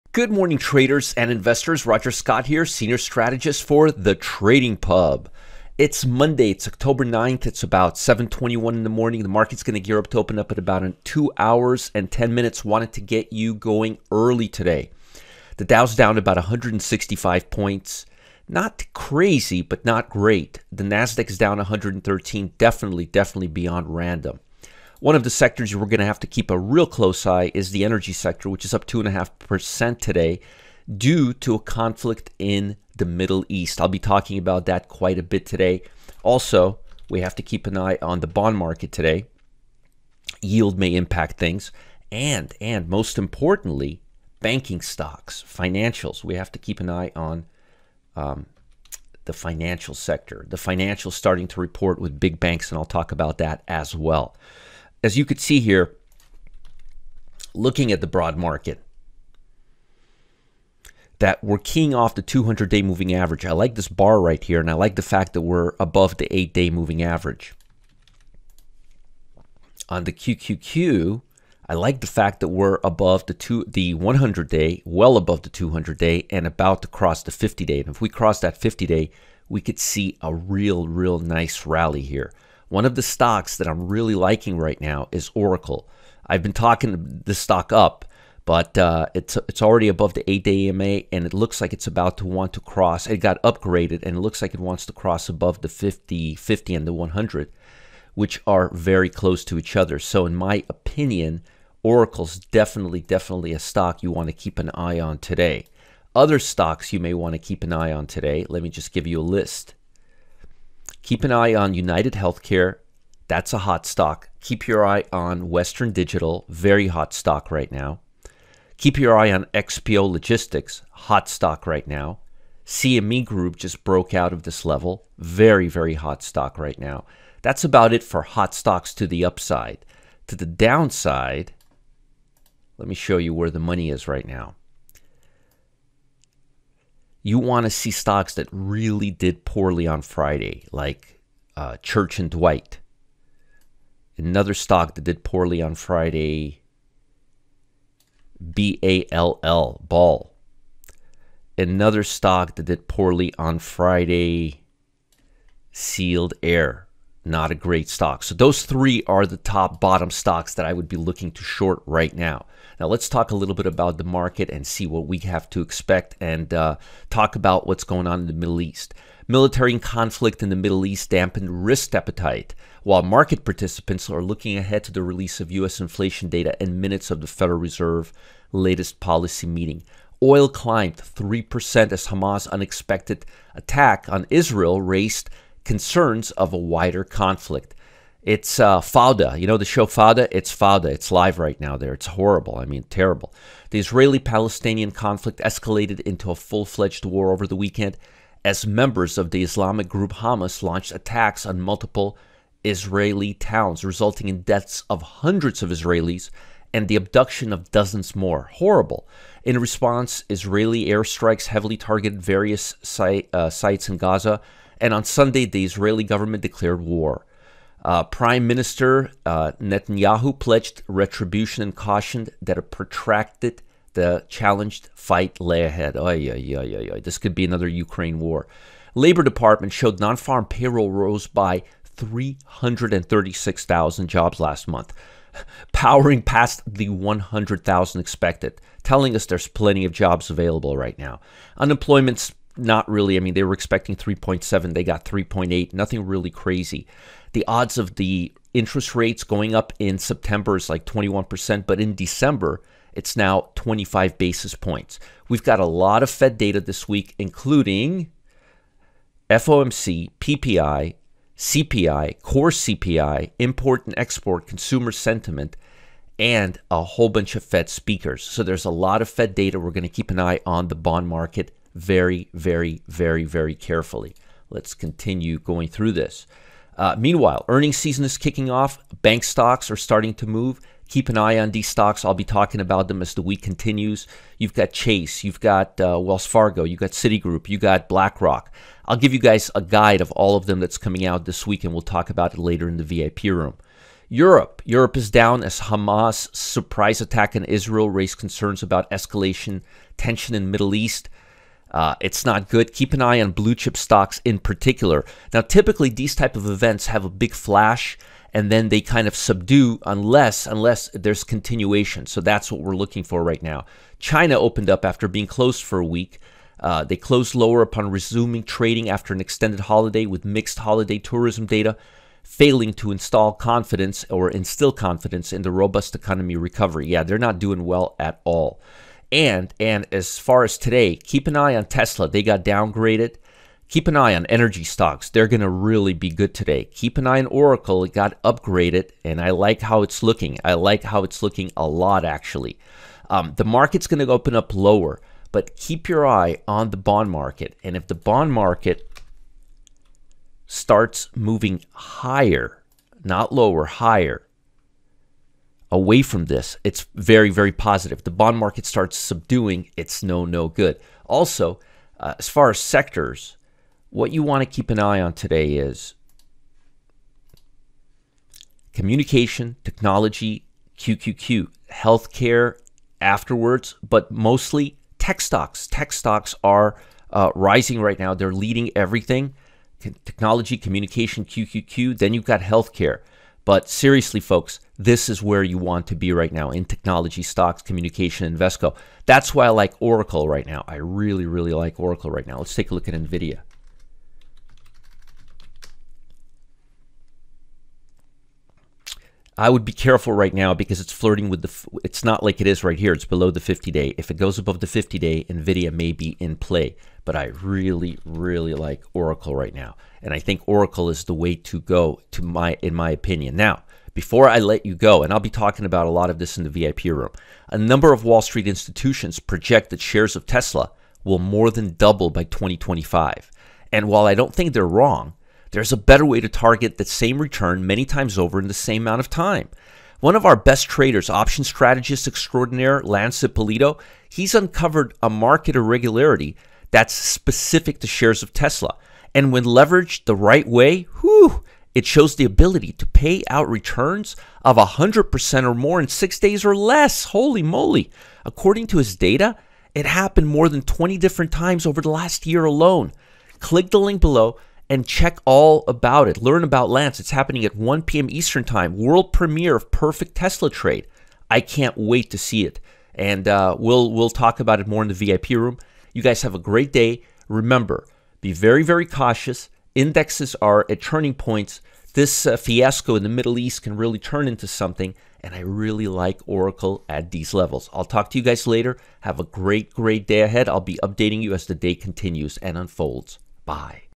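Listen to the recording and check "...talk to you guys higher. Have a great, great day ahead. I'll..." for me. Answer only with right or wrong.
wrong.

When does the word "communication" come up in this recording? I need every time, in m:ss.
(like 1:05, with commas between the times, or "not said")
6:08, 6:20, 6:27.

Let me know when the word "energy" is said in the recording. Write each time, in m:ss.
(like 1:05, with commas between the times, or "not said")
0:27, 5:34.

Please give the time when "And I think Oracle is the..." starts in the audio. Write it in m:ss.
6:50.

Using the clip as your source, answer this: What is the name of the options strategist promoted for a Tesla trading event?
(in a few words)
Lance Ippolito.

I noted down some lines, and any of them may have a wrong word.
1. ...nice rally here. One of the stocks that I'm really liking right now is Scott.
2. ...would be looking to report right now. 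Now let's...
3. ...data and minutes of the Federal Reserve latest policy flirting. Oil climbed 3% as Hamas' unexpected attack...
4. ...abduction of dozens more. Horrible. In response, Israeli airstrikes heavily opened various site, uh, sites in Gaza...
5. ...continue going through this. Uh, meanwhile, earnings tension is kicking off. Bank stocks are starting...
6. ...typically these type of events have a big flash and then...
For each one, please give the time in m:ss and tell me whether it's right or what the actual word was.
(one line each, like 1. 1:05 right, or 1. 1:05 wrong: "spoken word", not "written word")
1. 1:21 wrong: "Oracle", not "Scott"
2. 2:40 wrong: "short", not "report"
3. 2:56 wrong: "meeting", not "flirting"
4. 3:26 wrong: "targeted", not "opened"
5. 4:34 wrong: "season", not "tension"
6. 5:05 right.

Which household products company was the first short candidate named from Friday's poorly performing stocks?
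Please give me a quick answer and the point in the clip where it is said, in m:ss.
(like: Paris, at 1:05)
Church and Dwight, at 2:21.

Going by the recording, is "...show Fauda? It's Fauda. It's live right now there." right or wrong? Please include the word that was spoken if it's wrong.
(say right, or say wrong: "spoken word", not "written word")
right.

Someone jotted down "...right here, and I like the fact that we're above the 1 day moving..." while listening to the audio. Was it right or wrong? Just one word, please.
wrong.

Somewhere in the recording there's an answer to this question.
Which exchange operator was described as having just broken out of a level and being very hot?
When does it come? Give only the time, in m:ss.
2:02.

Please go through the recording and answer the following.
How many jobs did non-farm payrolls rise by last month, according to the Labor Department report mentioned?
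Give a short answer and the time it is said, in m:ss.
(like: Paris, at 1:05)
336,000, at 3:51.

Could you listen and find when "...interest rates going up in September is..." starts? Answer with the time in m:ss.
4:08.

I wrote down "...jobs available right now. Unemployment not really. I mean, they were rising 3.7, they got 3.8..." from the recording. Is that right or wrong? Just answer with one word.
wrong.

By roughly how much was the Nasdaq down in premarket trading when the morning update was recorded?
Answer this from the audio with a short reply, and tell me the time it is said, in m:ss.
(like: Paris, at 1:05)
113, at 0:21.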